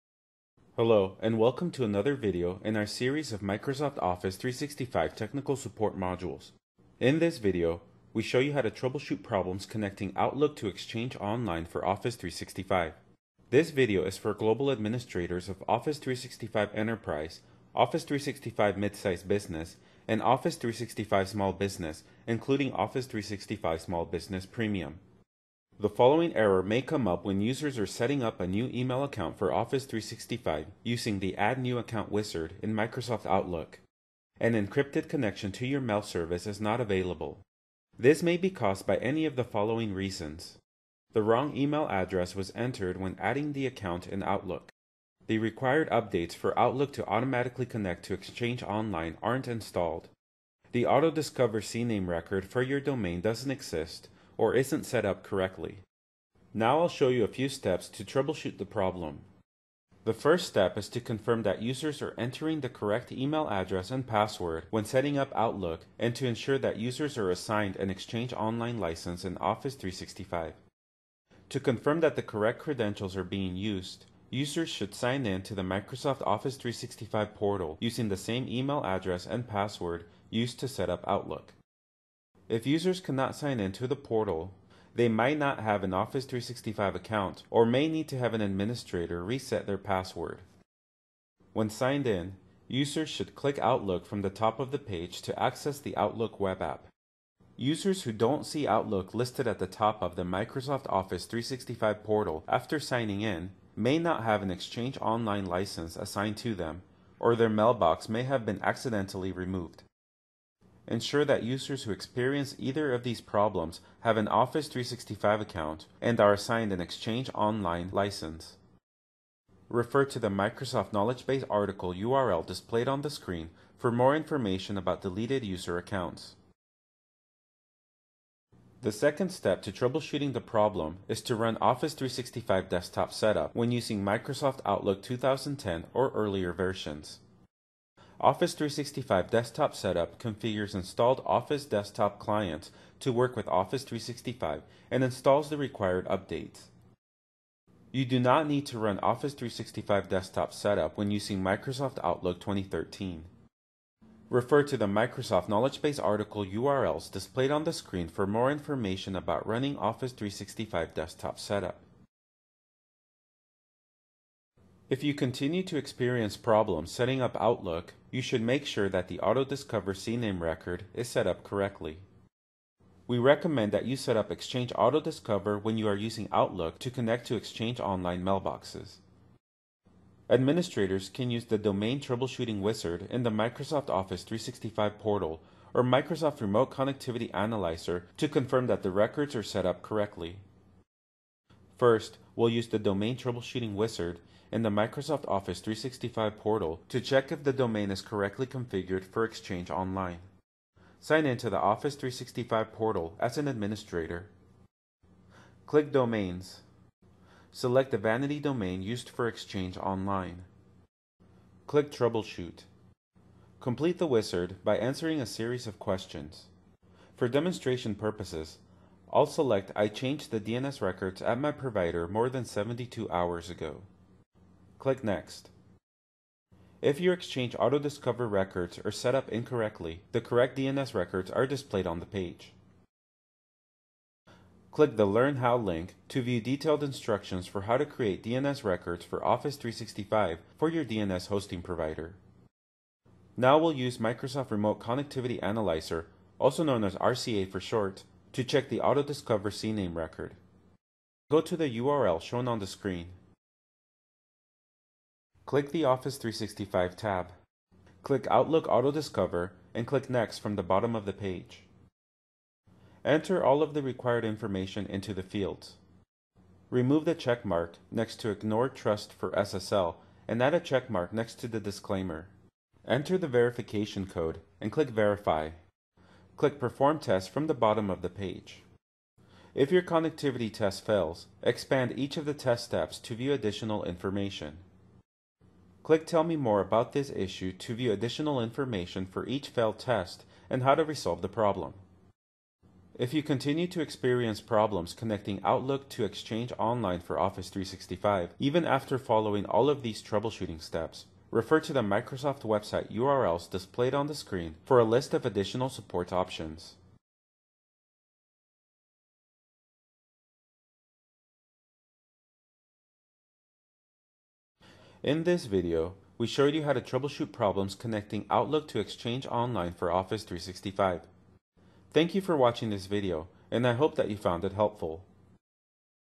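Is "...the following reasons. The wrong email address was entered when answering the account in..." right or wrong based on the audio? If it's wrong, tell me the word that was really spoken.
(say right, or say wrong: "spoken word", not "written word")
wrong: "adding", not "answering".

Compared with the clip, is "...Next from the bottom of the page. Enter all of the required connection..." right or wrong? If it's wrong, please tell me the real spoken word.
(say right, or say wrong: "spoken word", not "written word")
wrong: "information", not "connection".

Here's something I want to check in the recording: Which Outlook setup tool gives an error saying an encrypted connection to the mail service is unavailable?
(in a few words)
Add New Account wizard.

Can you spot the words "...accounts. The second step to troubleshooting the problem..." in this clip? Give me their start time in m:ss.
2:05.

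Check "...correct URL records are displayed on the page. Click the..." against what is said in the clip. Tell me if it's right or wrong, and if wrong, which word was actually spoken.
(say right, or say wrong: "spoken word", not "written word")
wrong: "DNS", not "URL".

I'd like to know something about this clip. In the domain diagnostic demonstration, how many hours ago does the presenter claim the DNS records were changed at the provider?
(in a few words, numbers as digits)
72.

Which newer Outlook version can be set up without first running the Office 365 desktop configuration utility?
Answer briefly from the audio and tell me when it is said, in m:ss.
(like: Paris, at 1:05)
Outlook 2013, at 2:32.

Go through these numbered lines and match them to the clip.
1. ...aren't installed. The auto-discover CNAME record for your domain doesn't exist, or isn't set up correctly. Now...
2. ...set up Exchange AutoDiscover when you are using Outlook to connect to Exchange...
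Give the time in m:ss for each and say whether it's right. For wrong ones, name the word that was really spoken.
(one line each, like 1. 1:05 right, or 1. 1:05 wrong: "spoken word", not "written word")
1. 0:49 right
2. 2:53 right.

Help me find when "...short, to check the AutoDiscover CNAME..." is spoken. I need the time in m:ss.
4:07.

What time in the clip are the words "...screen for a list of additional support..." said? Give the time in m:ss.
5:04.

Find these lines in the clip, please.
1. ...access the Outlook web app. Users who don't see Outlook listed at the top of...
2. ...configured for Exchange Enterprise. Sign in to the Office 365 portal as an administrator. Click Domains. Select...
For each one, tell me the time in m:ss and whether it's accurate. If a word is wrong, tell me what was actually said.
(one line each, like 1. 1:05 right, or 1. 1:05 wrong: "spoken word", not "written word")
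1. 1:35 right
2. 3:18 wrong: "Online", not "Enterprise".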